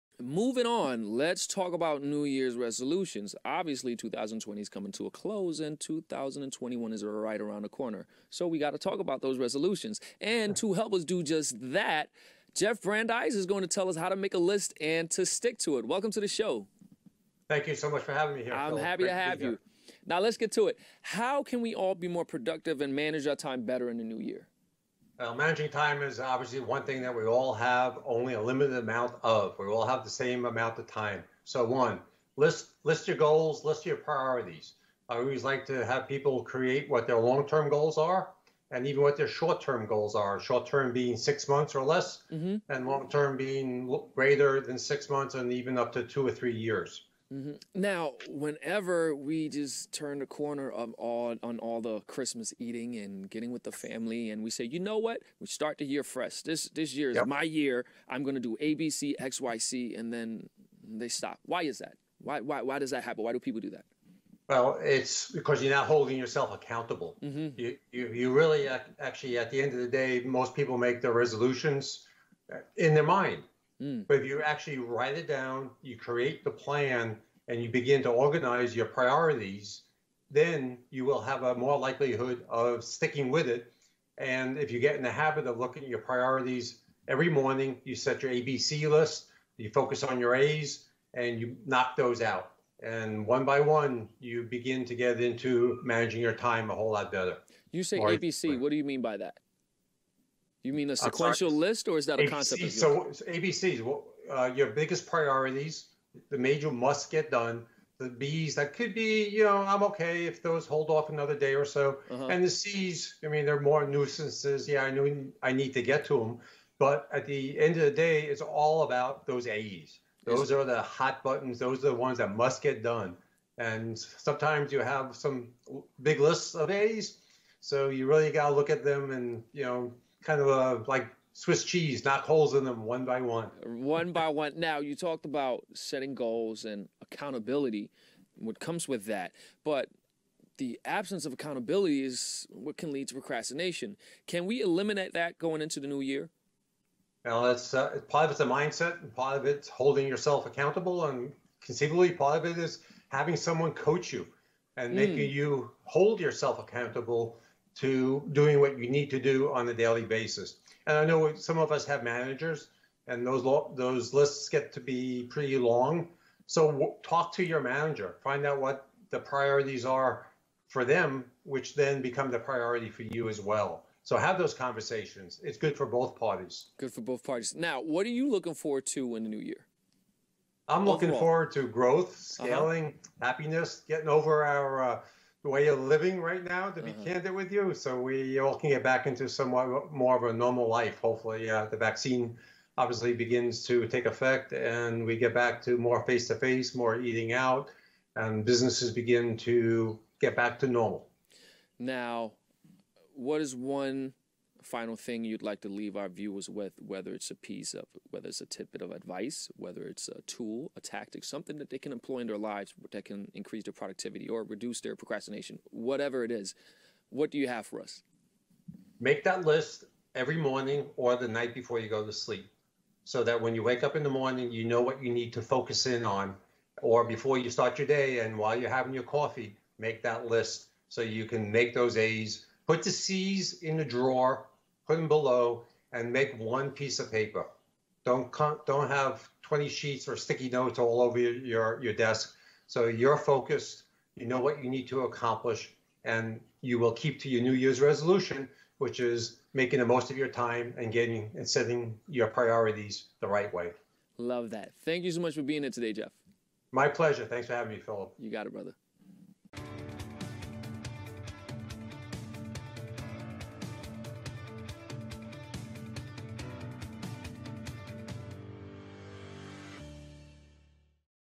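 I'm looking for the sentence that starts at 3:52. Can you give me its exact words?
Put the C's in the drawer put them below, and make one piece of paper.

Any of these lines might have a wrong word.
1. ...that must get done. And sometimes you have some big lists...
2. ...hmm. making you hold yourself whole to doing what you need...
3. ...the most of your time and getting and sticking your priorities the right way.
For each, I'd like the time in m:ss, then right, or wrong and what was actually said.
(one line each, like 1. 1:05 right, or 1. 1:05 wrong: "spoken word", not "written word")
1. 2:02 right
2. 2:34 wrong: "accountable", not "whole"
3. 4:09 wrong: "setting", not "sticking".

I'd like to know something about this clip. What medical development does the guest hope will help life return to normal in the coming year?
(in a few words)
the vaccine.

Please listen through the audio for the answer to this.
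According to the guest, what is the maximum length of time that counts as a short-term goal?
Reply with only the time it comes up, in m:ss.
0:41.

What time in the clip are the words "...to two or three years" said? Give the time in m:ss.
0:45.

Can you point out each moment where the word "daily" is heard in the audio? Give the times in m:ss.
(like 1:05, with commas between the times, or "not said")
2:39.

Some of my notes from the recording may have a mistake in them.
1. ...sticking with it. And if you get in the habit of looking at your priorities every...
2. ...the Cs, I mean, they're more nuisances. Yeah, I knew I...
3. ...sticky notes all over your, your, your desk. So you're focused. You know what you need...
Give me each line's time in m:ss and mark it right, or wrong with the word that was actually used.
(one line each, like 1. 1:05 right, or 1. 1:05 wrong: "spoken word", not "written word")
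1. 1:22 right
2. 1:52 right
3. 4:00 right.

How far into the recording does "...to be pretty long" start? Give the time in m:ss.
2:44.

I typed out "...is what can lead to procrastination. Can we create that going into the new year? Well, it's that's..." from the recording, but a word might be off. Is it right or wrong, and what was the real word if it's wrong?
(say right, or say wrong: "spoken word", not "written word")
wrong: "eliminate", not "create".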